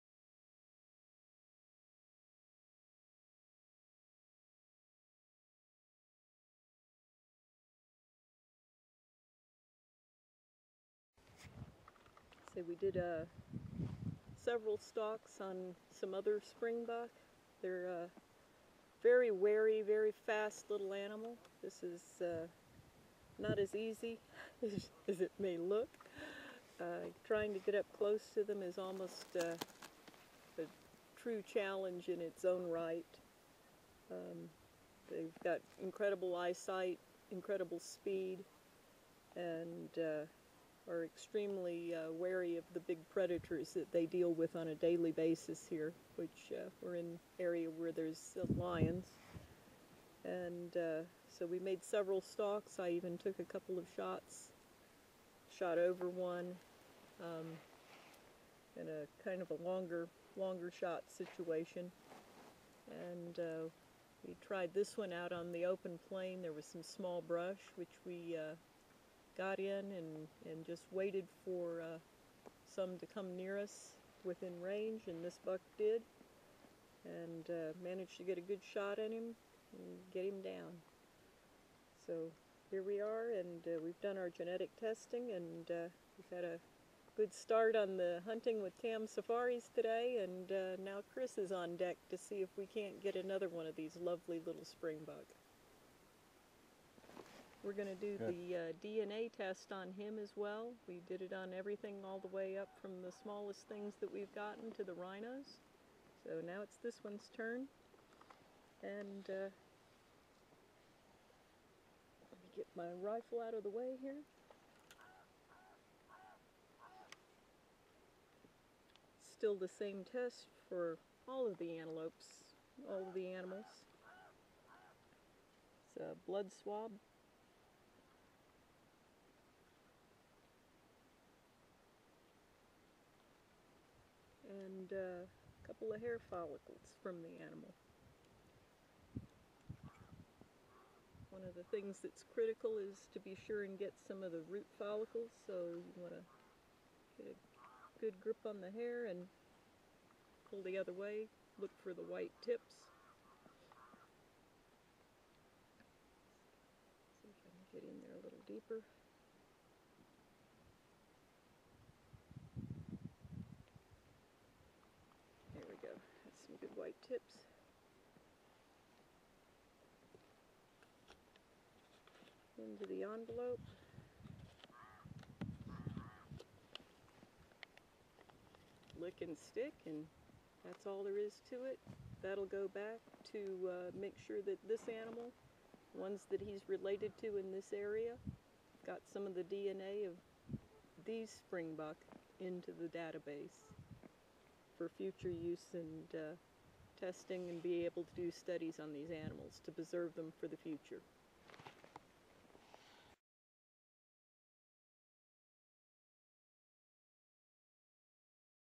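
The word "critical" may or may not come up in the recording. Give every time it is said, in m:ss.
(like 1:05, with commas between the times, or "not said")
2:22.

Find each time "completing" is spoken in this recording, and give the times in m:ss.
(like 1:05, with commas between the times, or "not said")
not said.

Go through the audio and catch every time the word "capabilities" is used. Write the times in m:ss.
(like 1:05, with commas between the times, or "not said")
not said.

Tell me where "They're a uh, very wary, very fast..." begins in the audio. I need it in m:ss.
0:17.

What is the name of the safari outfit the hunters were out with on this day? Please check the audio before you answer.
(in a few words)
Tam Safaris.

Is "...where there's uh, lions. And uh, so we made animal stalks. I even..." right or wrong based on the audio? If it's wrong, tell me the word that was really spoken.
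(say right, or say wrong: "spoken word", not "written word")
wrong: "several", not "animal".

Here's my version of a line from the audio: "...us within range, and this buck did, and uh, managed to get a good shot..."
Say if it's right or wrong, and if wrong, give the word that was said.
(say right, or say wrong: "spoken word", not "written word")
right.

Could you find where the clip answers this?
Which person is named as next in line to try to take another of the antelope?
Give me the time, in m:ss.
1:31.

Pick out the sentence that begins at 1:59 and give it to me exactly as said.
Still the same test for all of the antelopes, all of the animals.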